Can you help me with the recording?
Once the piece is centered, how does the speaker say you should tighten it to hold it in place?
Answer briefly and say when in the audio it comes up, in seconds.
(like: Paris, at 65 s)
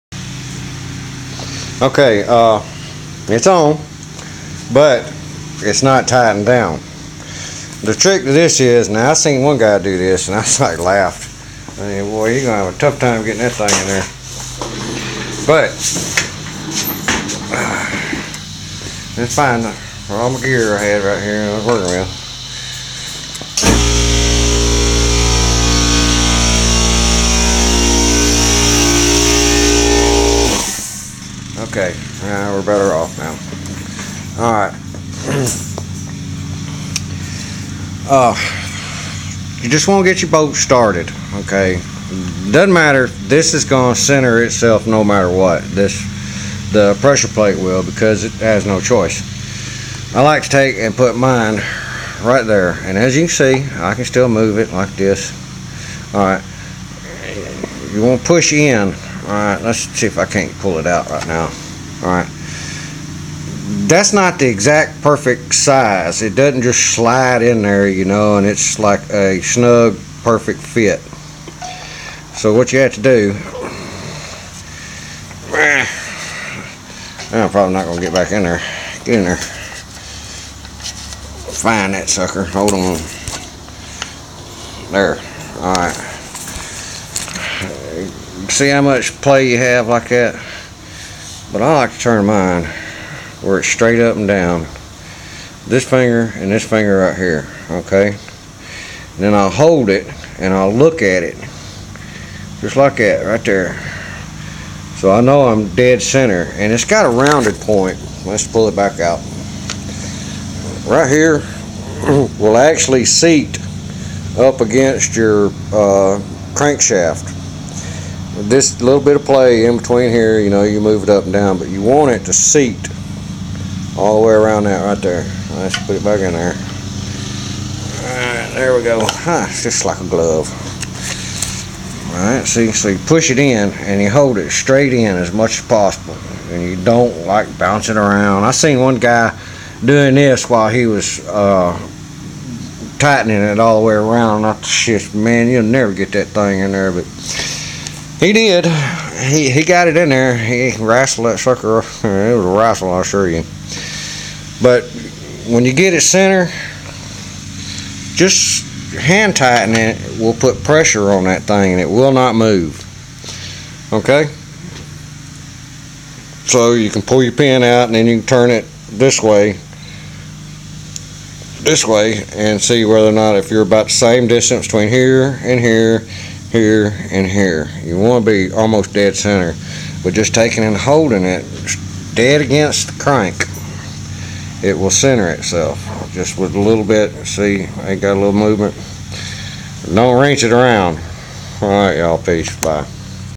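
Hand tighten, at 158 s.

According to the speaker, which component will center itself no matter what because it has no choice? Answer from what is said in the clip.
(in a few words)
Pressure plate.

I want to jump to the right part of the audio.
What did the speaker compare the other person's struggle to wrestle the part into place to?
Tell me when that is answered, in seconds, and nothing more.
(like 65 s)
152 s.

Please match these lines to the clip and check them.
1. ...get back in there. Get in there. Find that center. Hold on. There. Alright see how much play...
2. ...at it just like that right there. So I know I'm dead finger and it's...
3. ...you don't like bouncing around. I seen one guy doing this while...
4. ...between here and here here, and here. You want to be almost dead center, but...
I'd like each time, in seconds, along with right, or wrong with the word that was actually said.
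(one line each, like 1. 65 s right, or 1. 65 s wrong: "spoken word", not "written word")
1. 78 s wrong: "sucker", not "center"
2. 101 s wrong: "center", not "finger"
3. 136 s right
4. 174 s right.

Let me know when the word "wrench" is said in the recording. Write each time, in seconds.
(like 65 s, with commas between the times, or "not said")
190 s.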